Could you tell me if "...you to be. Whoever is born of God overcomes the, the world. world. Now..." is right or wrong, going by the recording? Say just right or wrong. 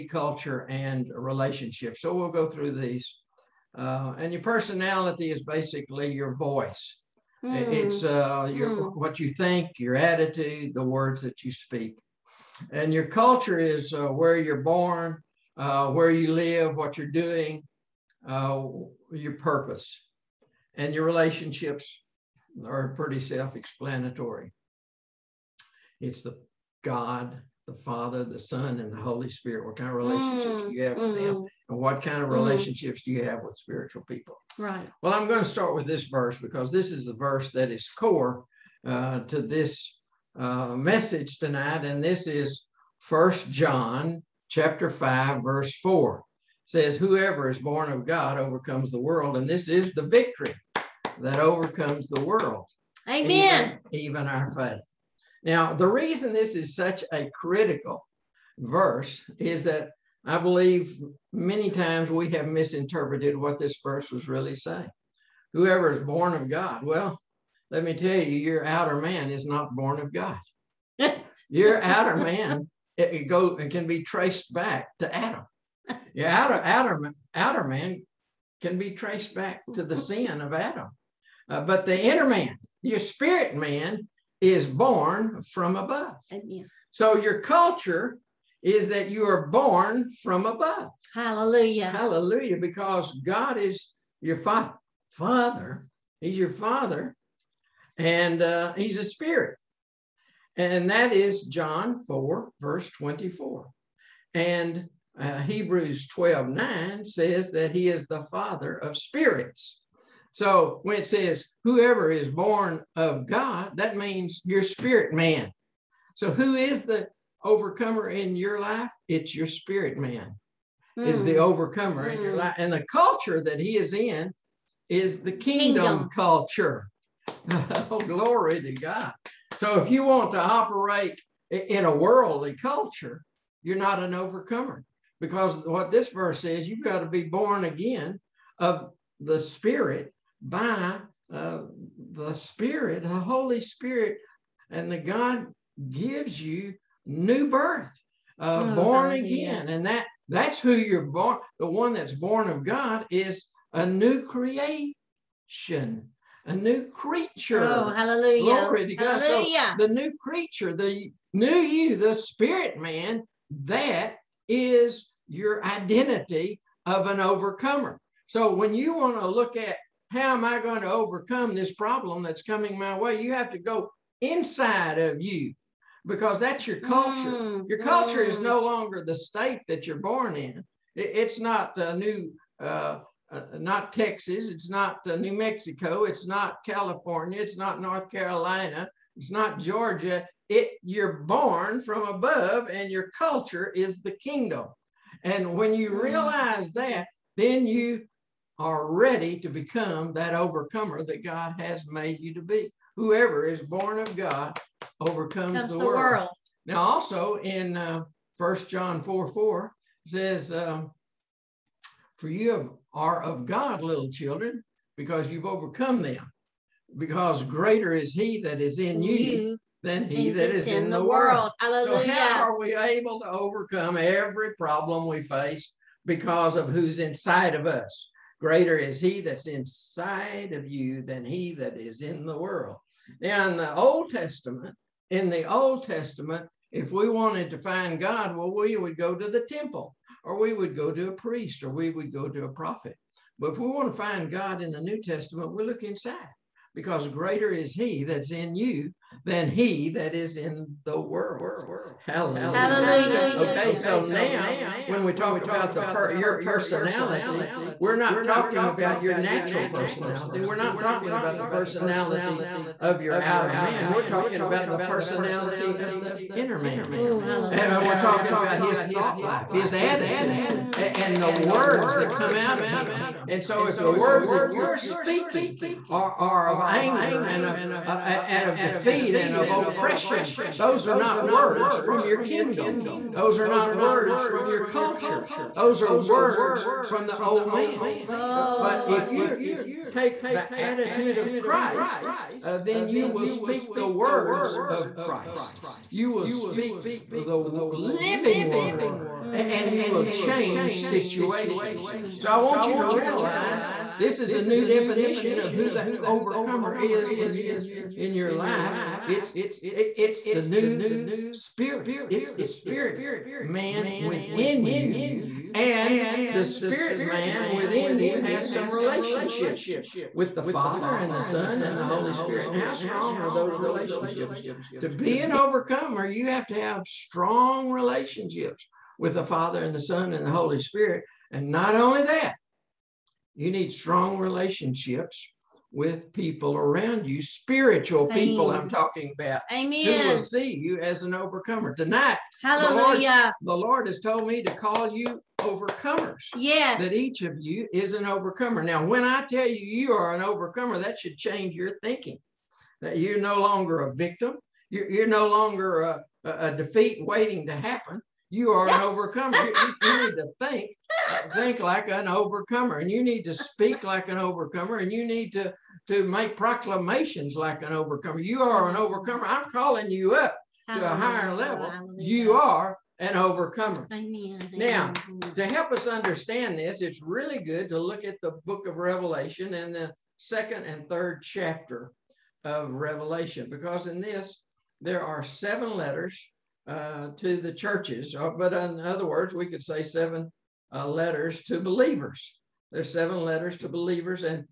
right.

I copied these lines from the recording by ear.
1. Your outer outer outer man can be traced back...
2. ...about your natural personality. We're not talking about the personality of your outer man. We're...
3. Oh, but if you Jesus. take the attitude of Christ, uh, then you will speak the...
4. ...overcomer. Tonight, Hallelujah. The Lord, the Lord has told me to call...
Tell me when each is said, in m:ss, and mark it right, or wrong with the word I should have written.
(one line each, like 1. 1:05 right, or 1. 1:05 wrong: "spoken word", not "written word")
1. 1:16 right
2. 4:18 right
3. 4:48 right
4. 5:41 right.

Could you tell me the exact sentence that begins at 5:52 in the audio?
That you're no longer a victim.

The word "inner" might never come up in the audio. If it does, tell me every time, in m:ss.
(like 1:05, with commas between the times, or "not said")
1:22, 4:26.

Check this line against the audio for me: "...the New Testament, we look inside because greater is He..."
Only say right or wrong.
right.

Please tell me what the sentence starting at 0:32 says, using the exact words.
relationships do you have with spiritual people?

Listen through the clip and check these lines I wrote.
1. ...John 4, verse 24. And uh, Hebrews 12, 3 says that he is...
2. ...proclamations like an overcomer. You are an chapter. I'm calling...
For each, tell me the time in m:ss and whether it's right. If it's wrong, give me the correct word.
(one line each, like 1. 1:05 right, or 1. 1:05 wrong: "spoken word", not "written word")
1. 1:41 wrong: "9", not "3"
2. 6:06 wrong: "overcomer", not "chapter".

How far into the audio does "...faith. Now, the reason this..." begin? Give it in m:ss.
0:54.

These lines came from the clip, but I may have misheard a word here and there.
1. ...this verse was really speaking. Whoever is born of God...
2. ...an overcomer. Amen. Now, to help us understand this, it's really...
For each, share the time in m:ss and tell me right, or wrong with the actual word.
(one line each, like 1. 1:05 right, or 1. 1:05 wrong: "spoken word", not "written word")
1. 1:03 wrong: "saying", not "speaking"
2. 6:12 right.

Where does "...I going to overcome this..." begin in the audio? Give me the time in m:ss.
2:50.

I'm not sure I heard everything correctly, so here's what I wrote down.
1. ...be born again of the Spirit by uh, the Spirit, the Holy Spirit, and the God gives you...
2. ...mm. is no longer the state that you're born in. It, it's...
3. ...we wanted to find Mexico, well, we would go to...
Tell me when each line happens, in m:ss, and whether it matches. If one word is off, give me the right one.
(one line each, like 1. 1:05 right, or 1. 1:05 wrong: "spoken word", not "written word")
1. 2:17 right
2. 2:58 right
3. 3:56 wrong: "God", not "Mexico".